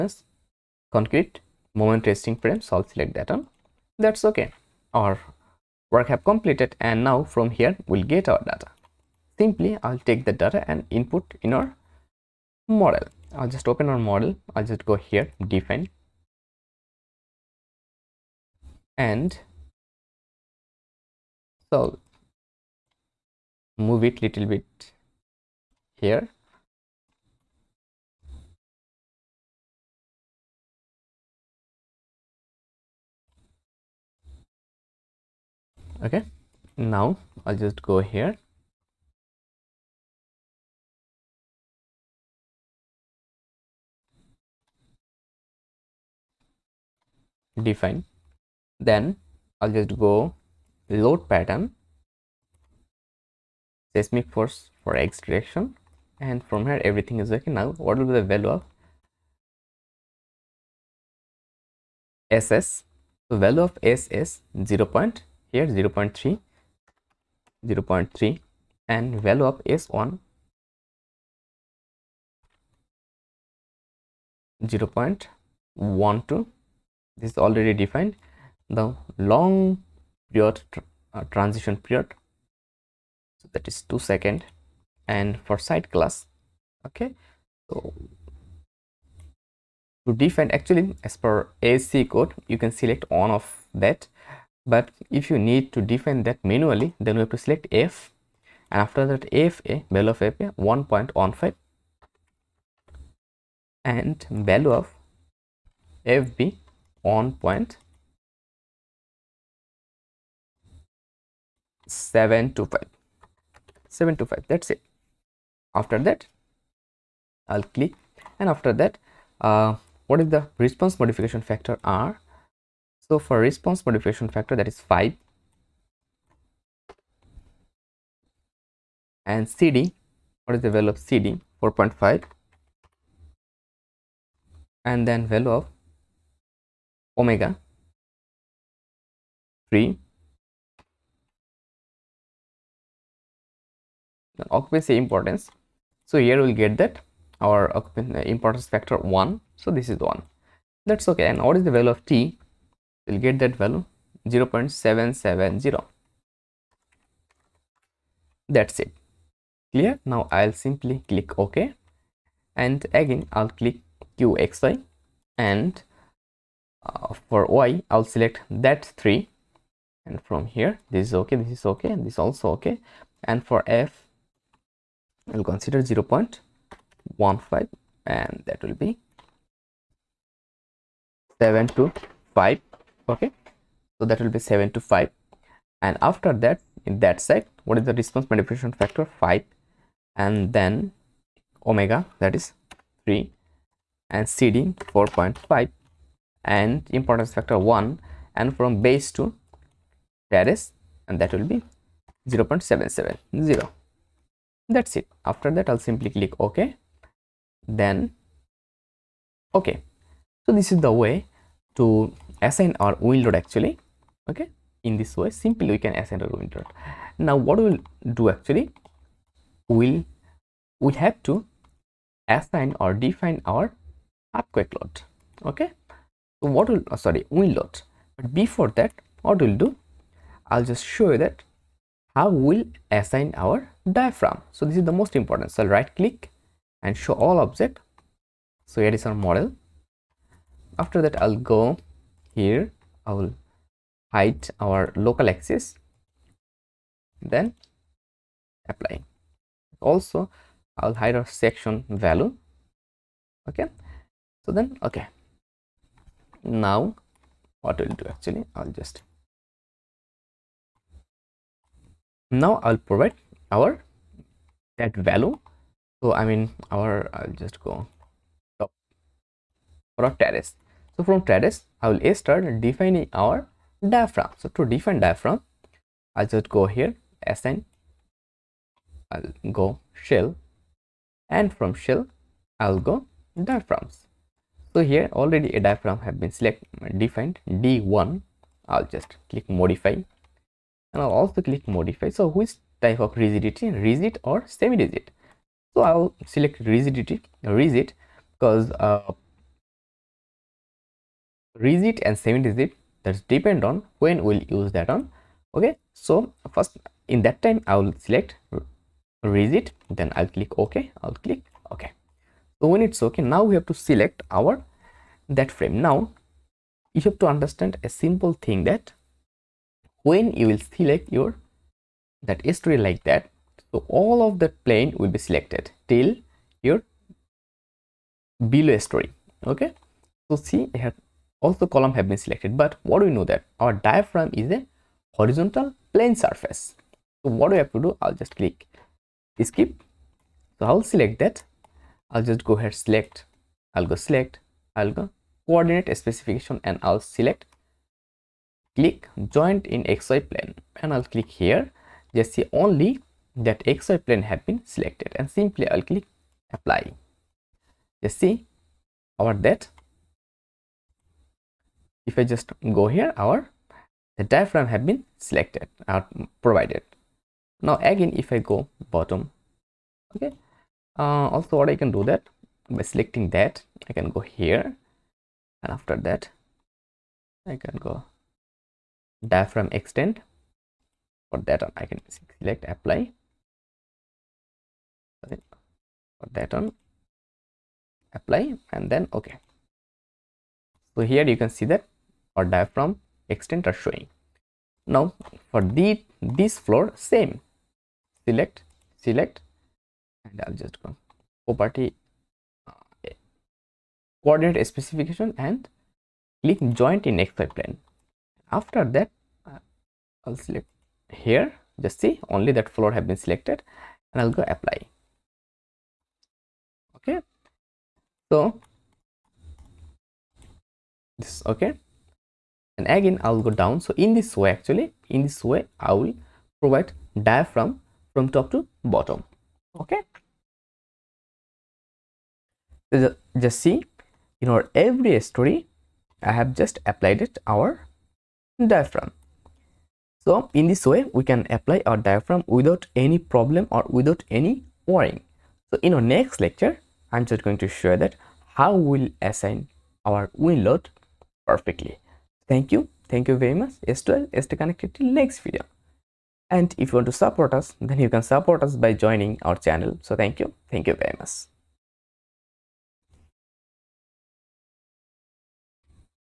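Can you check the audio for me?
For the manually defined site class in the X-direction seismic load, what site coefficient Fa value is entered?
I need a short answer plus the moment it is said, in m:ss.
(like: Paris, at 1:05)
1.15, at 1:40.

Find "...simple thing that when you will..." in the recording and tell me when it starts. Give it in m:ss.
5:17.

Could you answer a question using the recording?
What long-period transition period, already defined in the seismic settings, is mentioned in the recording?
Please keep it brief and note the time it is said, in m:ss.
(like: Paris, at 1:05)
2 seconds, at 1:23.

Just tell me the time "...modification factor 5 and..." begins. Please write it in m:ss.
3:08.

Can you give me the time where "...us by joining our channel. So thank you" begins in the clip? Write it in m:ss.
7:38.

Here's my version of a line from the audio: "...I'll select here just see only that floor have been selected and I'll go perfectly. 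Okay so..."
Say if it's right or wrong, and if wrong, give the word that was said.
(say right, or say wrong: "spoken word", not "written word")
wrong: "apply", not "perfectly".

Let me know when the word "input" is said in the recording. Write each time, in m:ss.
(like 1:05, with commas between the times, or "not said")
0:10.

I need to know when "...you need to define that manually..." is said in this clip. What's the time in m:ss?
1:35.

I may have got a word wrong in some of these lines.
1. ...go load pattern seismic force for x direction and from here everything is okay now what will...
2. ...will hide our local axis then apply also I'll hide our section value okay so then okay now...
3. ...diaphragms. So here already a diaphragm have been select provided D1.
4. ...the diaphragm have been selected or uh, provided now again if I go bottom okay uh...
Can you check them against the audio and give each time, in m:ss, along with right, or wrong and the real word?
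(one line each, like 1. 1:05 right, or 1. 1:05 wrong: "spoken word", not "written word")
1. 0:49 right
2. 4:03 right
3. 4:43 wrong: "defined", not "provided"
4. 6:04 right.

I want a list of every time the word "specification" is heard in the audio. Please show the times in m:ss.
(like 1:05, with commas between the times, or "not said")
5:45, 6:44.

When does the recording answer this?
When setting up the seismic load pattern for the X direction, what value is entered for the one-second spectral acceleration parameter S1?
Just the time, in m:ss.
1:14.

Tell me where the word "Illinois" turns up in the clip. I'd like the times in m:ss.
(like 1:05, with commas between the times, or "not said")
not said.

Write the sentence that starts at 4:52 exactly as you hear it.
So which type of rigidity, rigid or semi-rigid?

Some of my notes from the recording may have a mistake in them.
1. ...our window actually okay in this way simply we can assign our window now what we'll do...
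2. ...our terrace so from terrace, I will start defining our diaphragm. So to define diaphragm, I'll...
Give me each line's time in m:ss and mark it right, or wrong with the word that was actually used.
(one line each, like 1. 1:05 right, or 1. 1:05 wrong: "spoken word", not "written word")
1. 3:32 right
2. 4:30 right.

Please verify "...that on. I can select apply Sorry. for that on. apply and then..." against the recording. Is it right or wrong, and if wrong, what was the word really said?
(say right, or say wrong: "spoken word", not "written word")
right.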